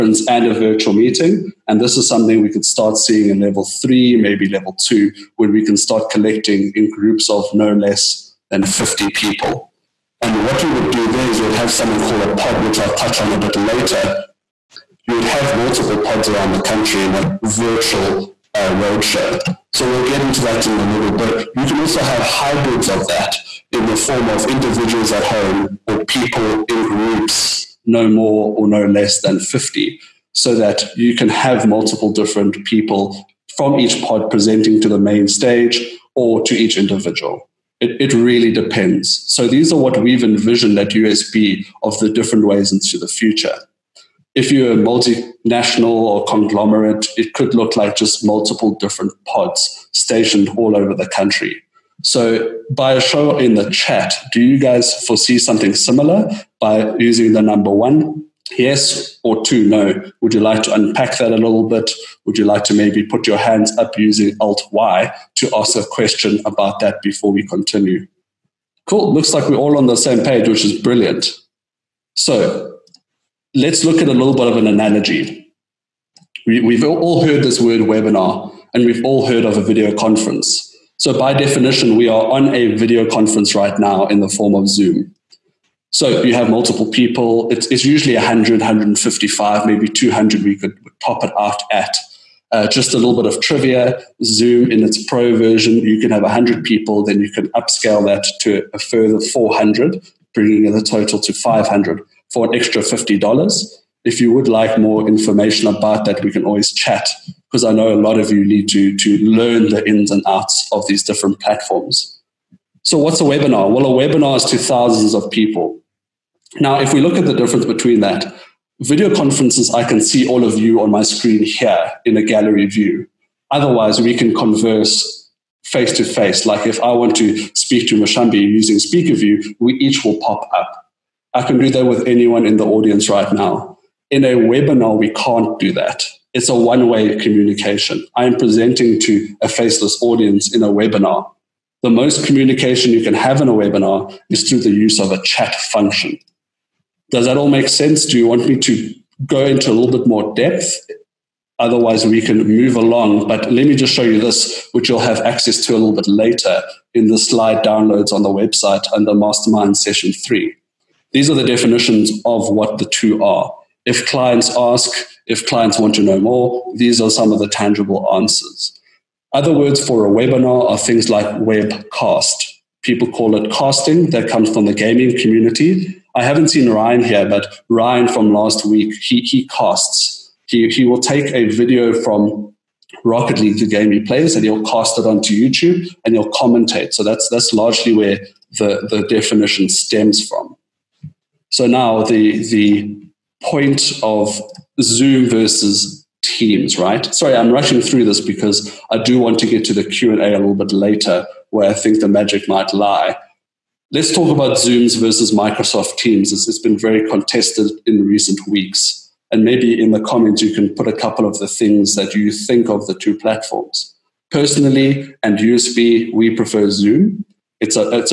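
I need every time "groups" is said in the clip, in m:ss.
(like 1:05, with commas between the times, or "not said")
0:06, 0:26.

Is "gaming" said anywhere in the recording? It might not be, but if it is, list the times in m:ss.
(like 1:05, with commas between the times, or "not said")
2:54.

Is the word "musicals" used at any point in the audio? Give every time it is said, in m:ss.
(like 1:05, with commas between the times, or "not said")
not said.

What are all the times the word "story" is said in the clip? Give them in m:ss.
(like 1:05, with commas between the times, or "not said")
not said.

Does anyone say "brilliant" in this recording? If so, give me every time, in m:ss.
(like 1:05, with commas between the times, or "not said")
1:10.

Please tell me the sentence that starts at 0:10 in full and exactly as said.
And what you would do there is you would have something called a pod, which I'll touch on a bit later.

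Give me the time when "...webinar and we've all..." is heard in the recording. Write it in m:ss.
1:17.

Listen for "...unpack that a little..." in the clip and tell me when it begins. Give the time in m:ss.
1:00.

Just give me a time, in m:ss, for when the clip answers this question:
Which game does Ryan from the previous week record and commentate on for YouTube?
3:03.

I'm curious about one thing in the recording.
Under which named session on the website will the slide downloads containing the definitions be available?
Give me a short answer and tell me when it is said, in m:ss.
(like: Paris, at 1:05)
Mastermind Session 3, at 2:39.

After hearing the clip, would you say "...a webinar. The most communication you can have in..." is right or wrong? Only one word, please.
right.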